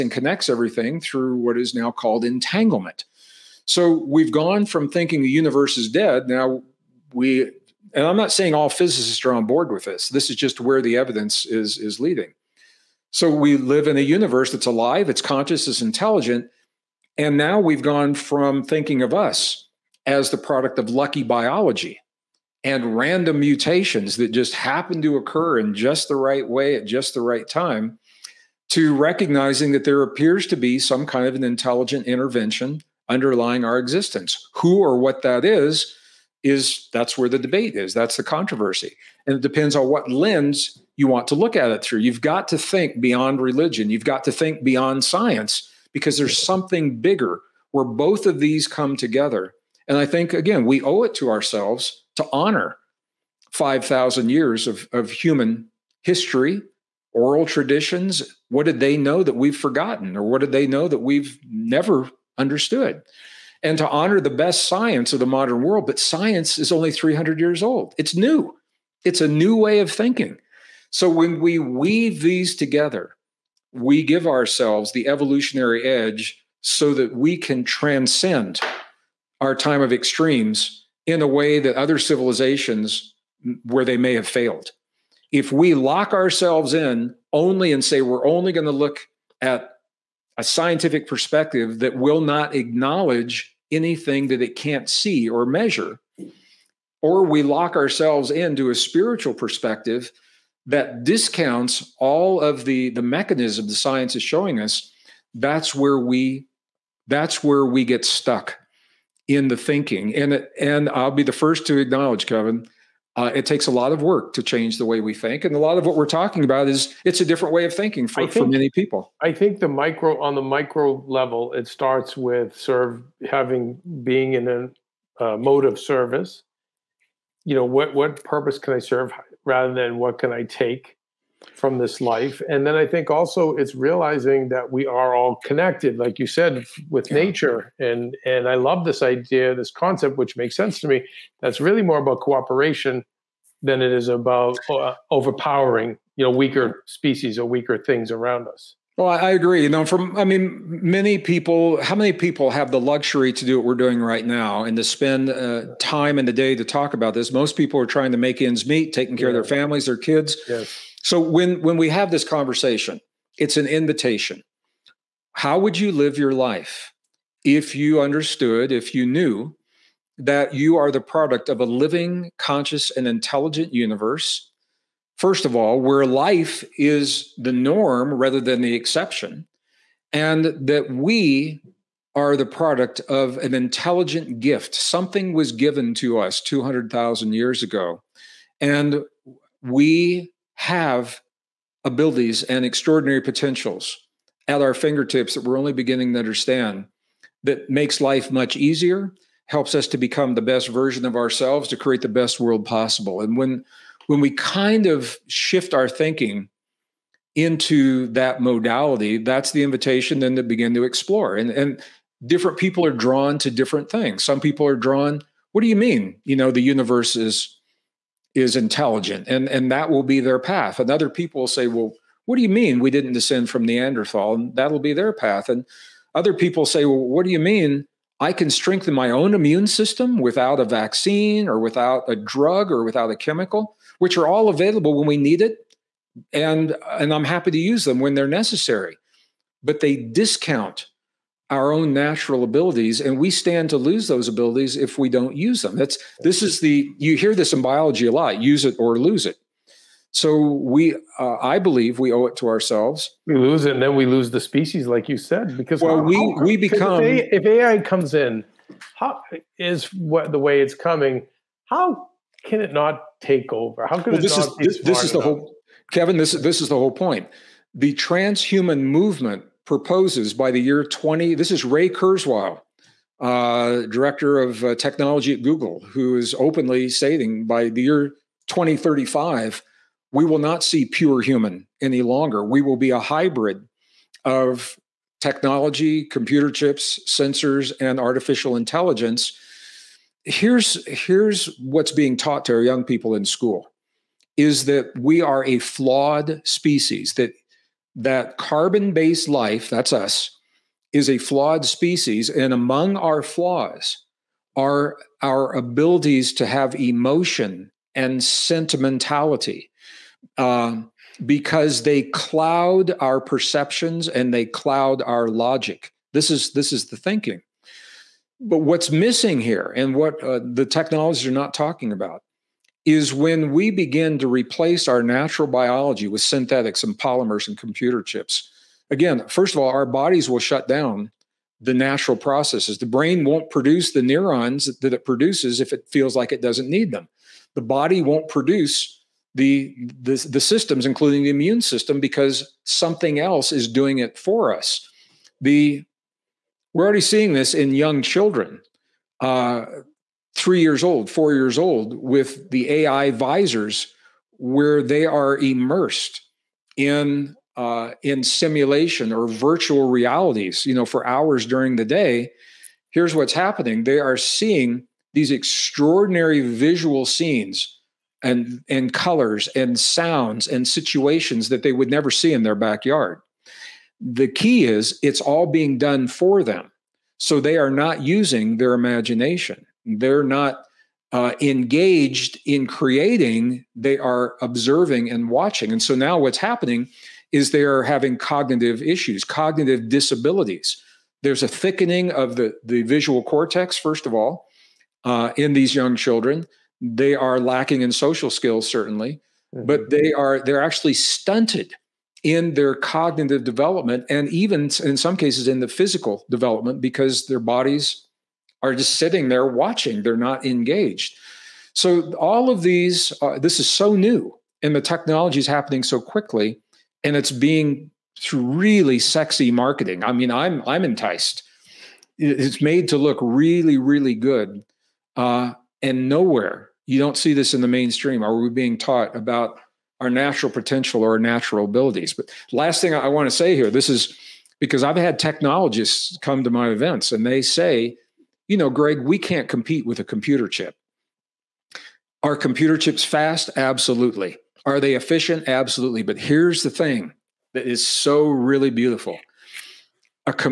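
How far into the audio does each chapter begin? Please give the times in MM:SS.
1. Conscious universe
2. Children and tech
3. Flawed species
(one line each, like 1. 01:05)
1. 02:04
2. 05:49
3. 03:40.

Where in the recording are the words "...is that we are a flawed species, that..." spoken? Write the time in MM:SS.
04:54.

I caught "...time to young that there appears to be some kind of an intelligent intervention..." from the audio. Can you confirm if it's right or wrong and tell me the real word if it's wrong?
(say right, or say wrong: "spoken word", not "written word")
wrong: "recognizing", not "young".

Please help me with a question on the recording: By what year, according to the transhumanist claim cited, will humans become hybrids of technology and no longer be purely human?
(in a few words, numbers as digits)
2035.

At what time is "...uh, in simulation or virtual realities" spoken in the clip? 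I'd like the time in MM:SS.
05:57.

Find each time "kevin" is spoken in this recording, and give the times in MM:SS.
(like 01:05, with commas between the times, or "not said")
01:52, 04:25.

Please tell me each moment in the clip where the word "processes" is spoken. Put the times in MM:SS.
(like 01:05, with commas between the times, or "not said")
05:32.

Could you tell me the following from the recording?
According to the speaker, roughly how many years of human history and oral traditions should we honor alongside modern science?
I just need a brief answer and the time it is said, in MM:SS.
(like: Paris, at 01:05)
5000, at 00:53.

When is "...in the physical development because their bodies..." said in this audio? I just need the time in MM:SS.
06:45.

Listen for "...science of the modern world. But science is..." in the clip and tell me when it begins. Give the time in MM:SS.
01:04.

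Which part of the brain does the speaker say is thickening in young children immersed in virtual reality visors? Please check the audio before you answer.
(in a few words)
visual cortex.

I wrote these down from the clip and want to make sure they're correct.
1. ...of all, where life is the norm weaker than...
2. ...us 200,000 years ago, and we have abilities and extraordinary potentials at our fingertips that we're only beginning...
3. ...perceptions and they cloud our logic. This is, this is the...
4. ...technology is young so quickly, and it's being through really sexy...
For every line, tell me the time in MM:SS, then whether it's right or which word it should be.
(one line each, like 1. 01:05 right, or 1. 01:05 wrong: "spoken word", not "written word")
1. 02:55 wrong: "rather", not "weaker"
2. 03:06 right
3. 05:13 right
4. 06:54 wrong: "happening", not "young".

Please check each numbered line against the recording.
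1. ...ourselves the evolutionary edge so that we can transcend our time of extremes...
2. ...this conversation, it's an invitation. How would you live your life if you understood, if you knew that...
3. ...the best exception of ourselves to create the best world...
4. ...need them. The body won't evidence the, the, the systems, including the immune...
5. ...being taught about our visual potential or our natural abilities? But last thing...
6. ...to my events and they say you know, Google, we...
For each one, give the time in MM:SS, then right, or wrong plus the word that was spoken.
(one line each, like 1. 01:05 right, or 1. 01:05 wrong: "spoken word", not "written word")
1. 01:14 right
2. 02:42 right
3. 03:20 wrong: "version", not "exception"
4. 05:36 wrong: "produce", not "evidence"
5. 07:08 wrong: "natural", not "visual"
6. 07:16 wrong: "Gregg", not "Google".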